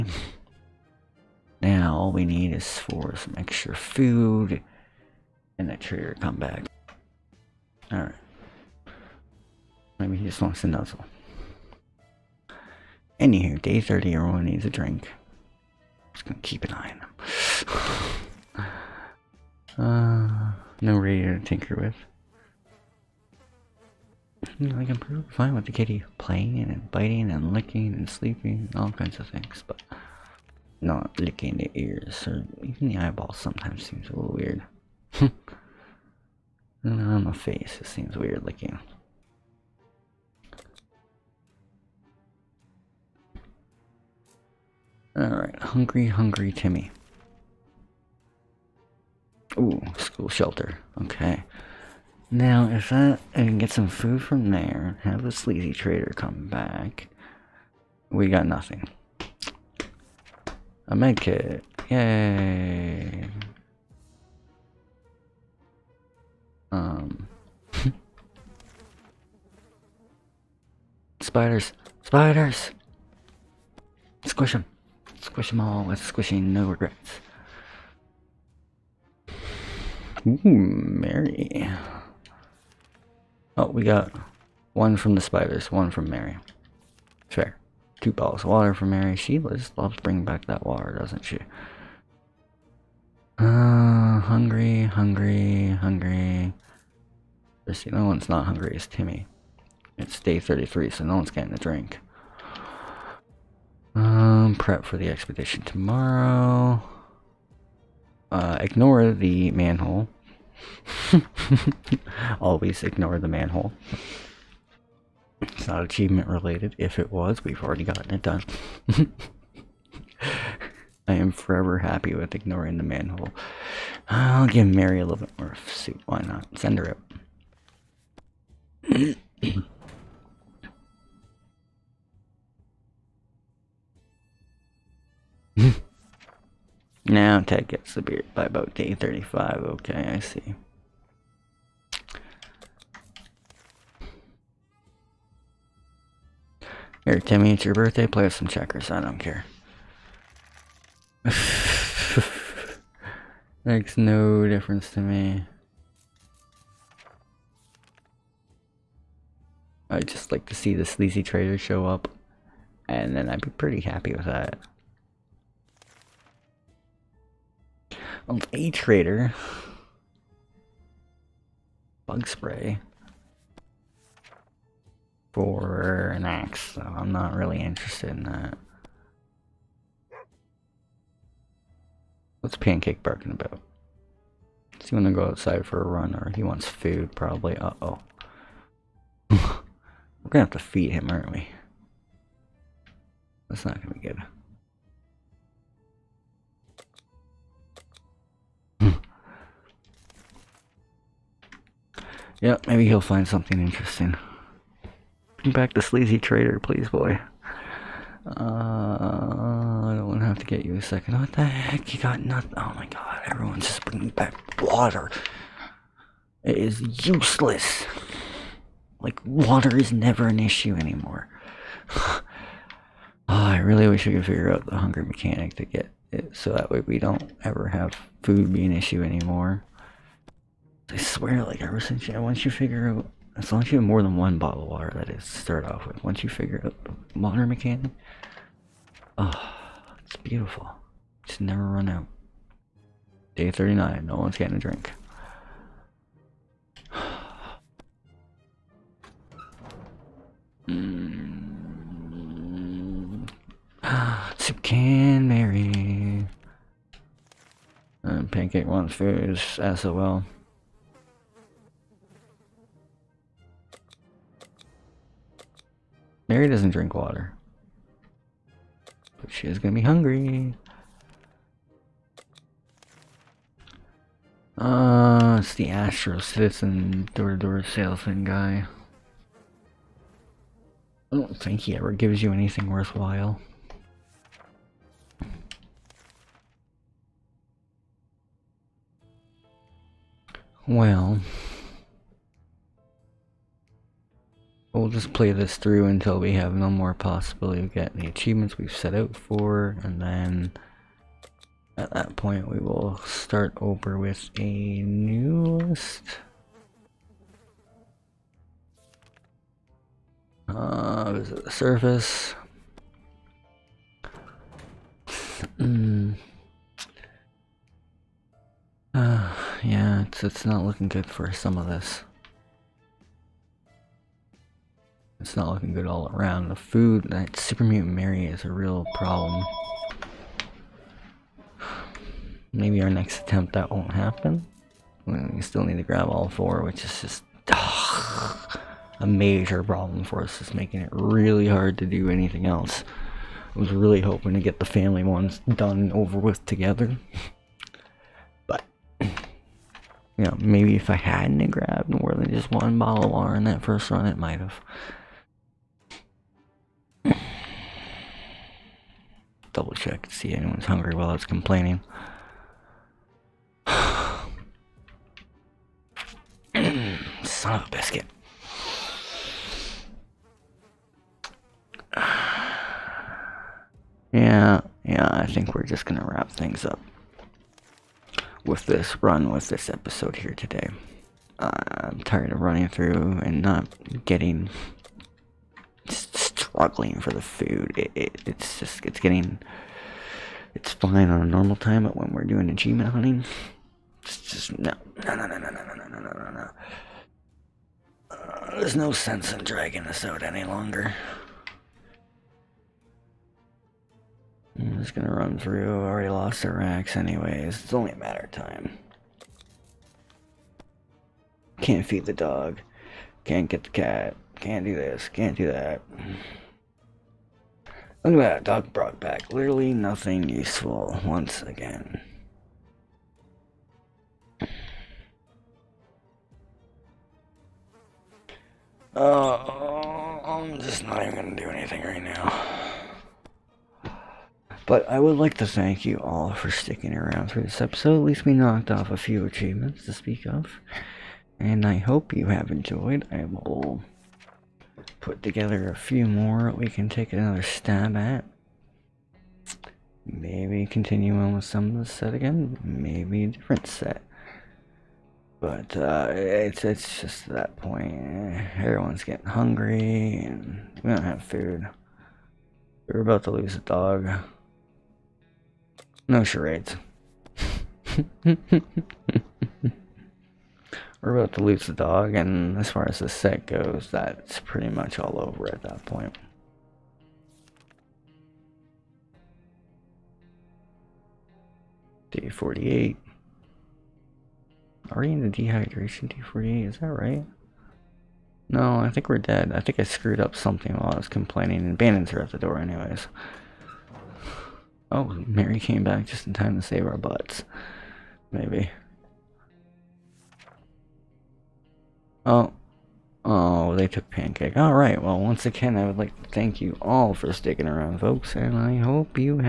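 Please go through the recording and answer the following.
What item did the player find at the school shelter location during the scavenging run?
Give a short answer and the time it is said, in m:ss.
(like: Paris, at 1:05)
A med kit, at 1:00.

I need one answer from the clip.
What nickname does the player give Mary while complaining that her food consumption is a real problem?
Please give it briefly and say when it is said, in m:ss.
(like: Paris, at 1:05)
Super Mutant Mary, at 5:27.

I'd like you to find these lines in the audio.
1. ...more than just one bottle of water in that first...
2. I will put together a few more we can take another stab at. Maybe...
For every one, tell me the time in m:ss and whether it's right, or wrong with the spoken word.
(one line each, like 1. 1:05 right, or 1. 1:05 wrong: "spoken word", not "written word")
1. 5:51 right
2. 7:23 right.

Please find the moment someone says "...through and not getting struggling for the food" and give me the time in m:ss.
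6:22.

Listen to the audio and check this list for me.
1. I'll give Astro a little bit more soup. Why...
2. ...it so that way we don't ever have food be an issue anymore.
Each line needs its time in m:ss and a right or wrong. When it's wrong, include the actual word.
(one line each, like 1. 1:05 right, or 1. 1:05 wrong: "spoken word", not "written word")
1. 2:04 wrong: "Mary", not "Astro"
2. 3:46 right.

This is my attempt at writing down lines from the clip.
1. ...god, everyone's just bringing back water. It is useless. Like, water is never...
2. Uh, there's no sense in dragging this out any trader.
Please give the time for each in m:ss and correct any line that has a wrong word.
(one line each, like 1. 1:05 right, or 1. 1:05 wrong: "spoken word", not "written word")
1. 3:32 right
2. 6:38 wrong: "longer", not "trader".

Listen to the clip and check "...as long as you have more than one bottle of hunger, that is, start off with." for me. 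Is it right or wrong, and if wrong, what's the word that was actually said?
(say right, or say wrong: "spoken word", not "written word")
wrong: "water", not "hunger".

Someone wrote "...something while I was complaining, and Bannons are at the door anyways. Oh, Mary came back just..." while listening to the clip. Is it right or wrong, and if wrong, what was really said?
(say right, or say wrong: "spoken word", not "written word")
right.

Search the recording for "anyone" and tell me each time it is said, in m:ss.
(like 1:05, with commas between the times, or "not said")
6:00.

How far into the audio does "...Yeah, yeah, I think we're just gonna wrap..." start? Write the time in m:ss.
6:14.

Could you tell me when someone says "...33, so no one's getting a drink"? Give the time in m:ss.
1:40.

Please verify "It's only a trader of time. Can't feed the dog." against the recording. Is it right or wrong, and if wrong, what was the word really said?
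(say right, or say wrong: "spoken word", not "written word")
wrong: "matter", not "trader".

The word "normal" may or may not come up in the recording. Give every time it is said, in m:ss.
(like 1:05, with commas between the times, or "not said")
6:31.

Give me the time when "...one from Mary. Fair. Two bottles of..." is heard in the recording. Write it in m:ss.
1:25.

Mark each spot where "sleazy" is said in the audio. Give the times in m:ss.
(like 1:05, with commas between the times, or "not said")
0:55, 2:40, 3:25.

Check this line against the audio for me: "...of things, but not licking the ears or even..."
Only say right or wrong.
right.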